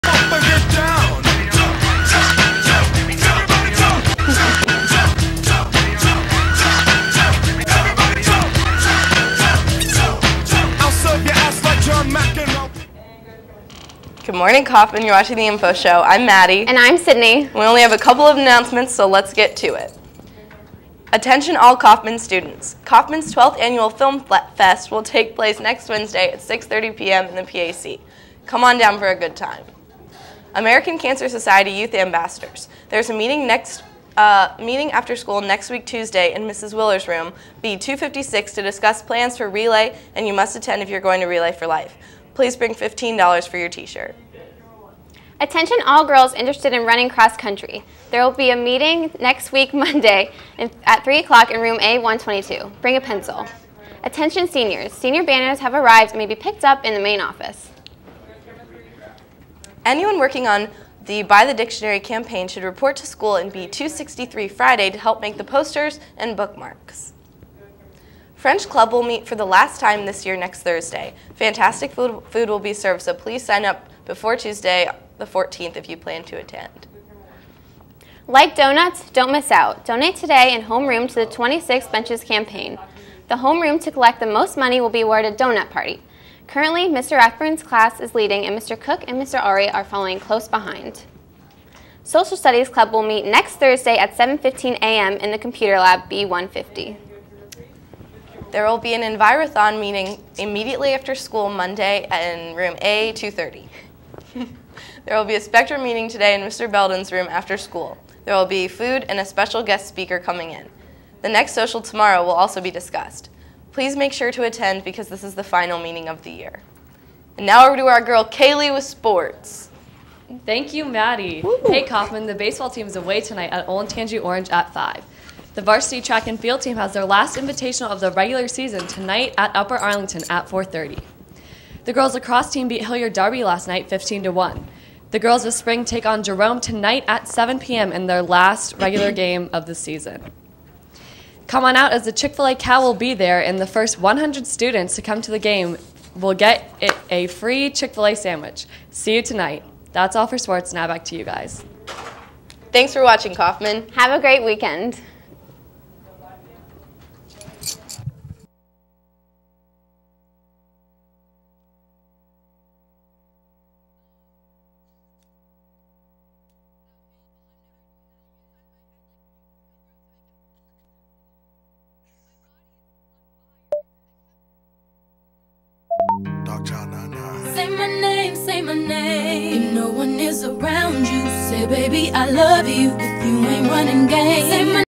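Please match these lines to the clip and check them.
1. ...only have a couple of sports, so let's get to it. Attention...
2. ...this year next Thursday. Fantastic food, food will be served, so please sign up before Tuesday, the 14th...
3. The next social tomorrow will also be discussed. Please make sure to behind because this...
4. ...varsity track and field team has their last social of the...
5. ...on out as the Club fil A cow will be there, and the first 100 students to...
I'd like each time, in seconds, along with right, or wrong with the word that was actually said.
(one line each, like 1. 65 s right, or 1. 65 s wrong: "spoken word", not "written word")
1. 17 s wrong: "announcements", not "sports"
2. 70 s right
3. 111 s wrong: "attend", not "behind"
4. 125 s wrong: "invitational", not "social"
5. 141 s wrong: "Chick", not "Club".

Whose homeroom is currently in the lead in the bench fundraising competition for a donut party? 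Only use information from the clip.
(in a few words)
Mr. Rathburn's.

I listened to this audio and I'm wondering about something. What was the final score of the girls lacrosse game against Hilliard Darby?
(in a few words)
15 to 1.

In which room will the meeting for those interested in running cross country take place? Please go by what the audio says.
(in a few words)
A122.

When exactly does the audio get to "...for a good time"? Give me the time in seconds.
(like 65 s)
28 s.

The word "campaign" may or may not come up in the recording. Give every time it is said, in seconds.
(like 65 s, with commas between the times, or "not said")
61 s, 82 s.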